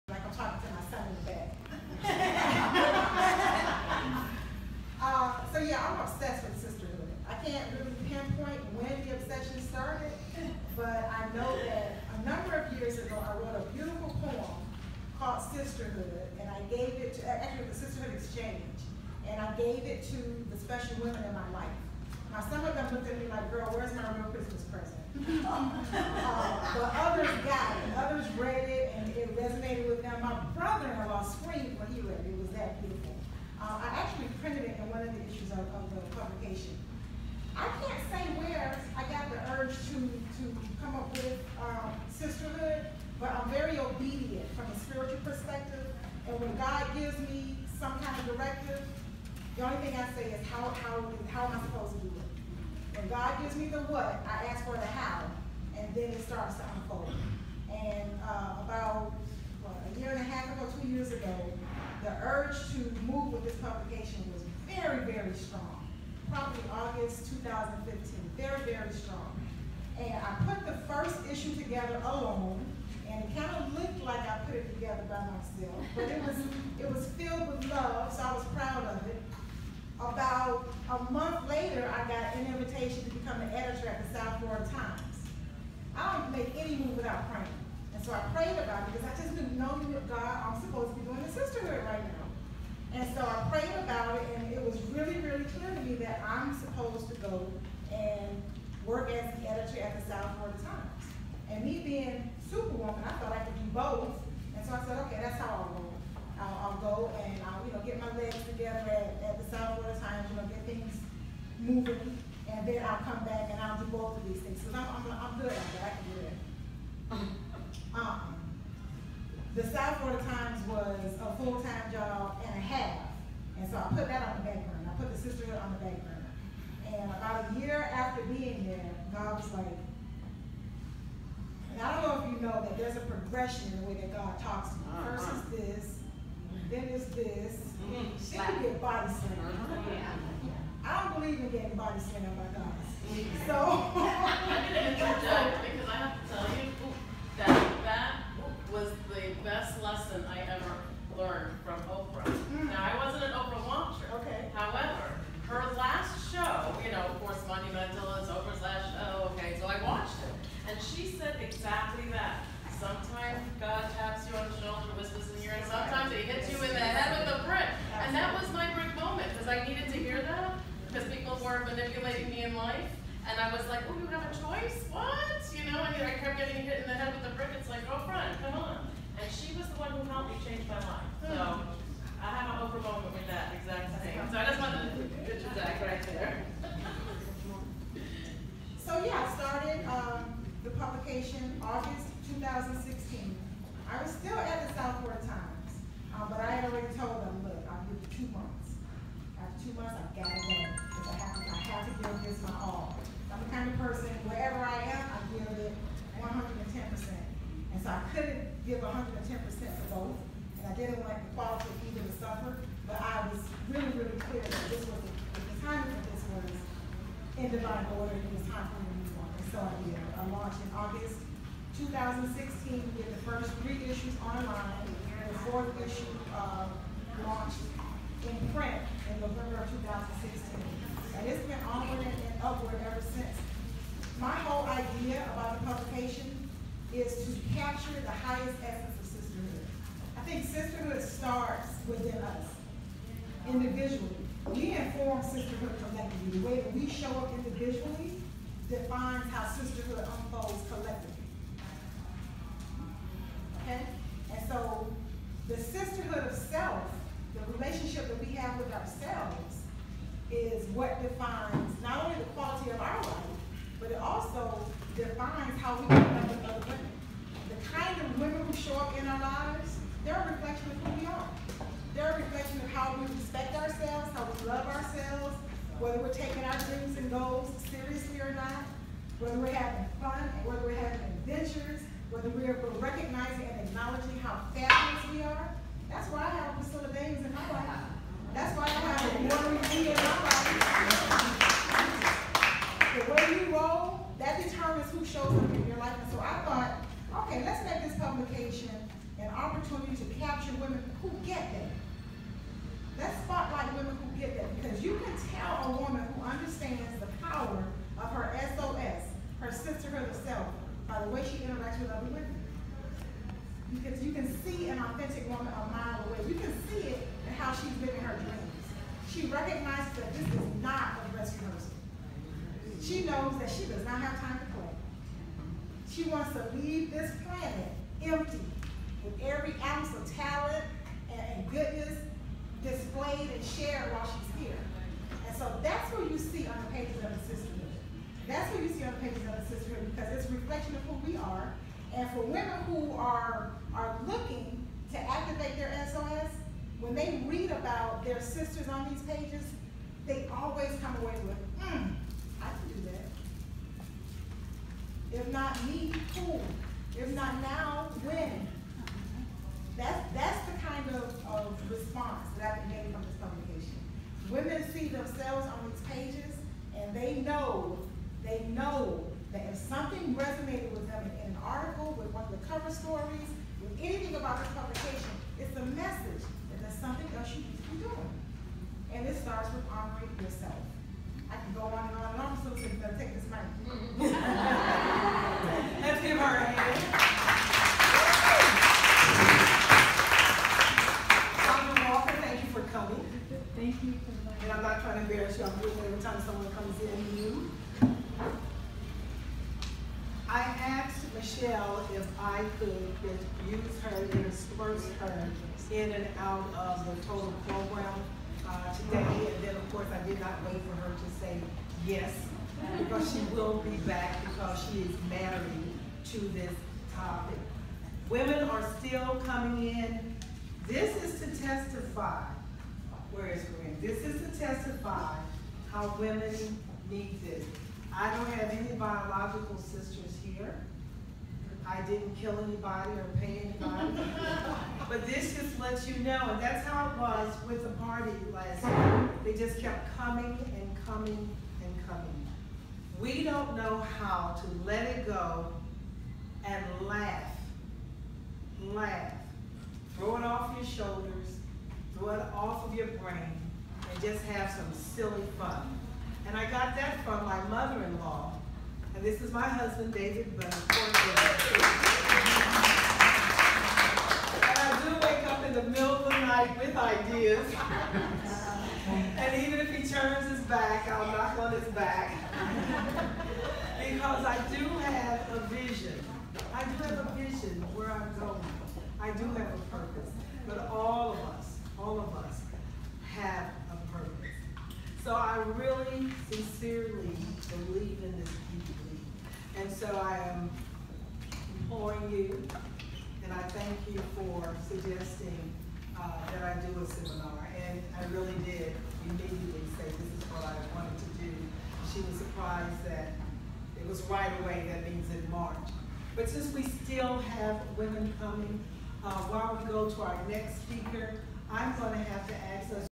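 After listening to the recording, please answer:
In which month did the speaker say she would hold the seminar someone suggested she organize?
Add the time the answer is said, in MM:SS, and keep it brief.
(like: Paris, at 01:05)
March, at 08:25.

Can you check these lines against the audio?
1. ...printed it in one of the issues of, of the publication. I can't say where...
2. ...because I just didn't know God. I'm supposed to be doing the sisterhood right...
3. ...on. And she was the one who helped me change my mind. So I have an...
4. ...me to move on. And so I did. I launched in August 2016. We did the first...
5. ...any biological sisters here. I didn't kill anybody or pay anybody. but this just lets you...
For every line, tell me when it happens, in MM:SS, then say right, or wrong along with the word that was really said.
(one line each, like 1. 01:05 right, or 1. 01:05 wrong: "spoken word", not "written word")
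1. 00:34 right
2. 01:28 right
3. 02:58 right
4. 03:38 right
5. 07:08 right.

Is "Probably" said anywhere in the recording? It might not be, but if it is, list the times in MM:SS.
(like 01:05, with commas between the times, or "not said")
01:06.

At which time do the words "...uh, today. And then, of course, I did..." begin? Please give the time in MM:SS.
06:48.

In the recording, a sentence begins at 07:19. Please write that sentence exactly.
They just kept coming and coming and coming.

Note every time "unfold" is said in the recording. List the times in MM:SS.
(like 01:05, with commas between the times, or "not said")
00:56, 04:09.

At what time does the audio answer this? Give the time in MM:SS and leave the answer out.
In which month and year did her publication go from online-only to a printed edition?
03:49.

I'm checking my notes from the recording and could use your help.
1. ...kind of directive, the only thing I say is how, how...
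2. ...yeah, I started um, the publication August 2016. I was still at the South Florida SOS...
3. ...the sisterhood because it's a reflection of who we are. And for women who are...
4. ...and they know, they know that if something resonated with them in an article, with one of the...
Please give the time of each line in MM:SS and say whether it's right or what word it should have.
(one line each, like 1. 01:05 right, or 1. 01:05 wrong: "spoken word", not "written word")
1. 00:47 right
2. 03:09 wrong: "Times", not "SOS"
3. 05:39 right
4. 06:06 right.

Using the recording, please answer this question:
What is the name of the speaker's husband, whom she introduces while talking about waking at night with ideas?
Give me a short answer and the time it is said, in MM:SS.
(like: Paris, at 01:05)
David Bunn, at 07:39.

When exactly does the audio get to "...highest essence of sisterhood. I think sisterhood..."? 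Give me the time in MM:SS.
03:58.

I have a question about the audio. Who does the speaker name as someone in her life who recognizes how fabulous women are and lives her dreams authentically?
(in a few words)
Priscilla Davis.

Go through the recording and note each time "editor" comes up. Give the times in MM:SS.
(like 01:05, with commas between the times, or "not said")
01:23, 01:39.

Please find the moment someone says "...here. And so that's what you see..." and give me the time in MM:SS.
05:34.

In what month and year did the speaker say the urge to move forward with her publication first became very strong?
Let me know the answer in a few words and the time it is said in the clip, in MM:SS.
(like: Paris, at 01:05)
August 2015, at 01:06.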